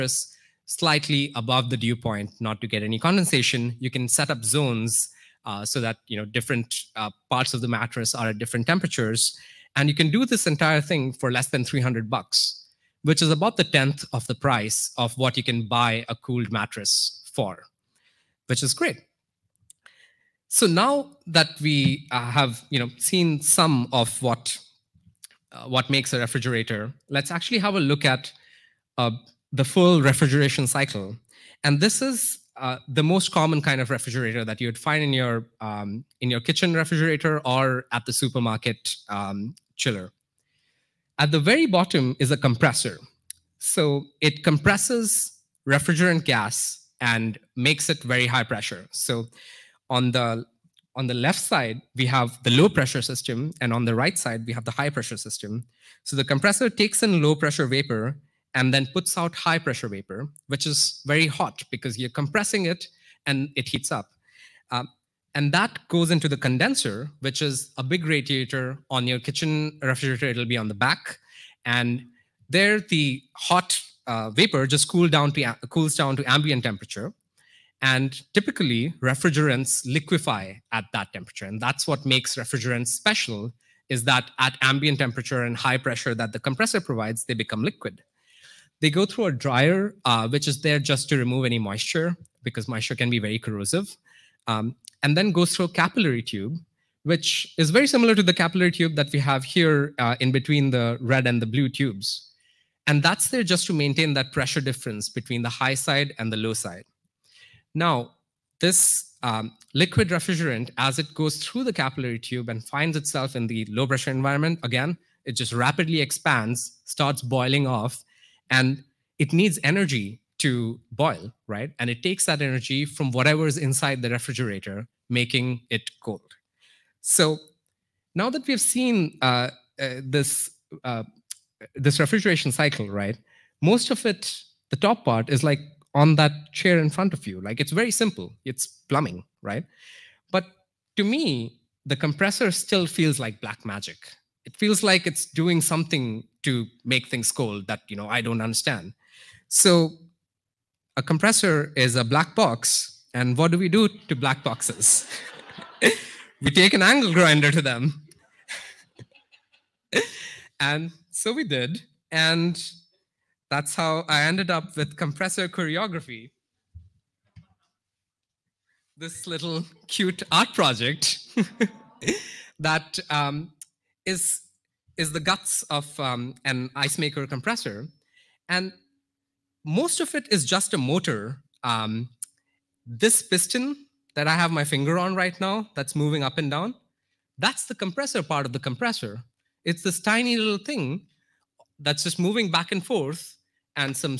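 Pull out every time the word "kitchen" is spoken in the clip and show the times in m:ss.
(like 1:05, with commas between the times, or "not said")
0:36, 1:09.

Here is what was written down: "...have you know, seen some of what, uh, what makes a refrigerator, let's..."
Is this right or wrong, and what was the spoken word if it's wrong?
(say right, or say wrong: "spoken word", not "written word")
right.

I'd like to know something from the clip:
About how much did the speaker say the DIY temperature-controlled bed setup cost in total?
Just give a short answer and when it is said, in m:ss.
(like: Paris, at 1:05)
Less than $300, at 0:11.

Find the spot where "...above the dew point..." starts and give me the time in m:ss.
0:01.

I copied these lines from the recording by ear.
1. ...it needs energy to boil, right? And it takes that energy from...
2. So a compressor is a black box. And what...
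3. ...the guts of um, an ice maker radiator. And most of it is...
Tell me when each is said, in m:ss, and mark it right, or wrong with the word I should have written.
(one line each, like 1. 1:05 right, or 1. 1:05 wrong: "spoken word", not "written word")
1. 1:59 right
2. 2:29 right
3. 2:55 wrong: "compressor", not "radiator".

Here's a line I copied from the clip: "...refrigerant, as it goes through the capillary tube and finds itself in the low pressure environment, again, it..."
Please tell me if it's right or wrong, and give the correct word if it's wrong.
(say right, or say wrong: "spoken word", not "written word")
right.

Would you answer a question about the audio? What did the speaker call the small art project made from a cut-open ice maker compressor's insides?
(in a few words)
Compressor choreography.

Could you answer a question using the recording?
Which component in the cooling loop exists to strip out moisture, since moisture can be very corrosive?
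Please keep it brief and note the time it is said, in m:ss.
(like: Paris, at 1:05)
Dryer, at 1:29.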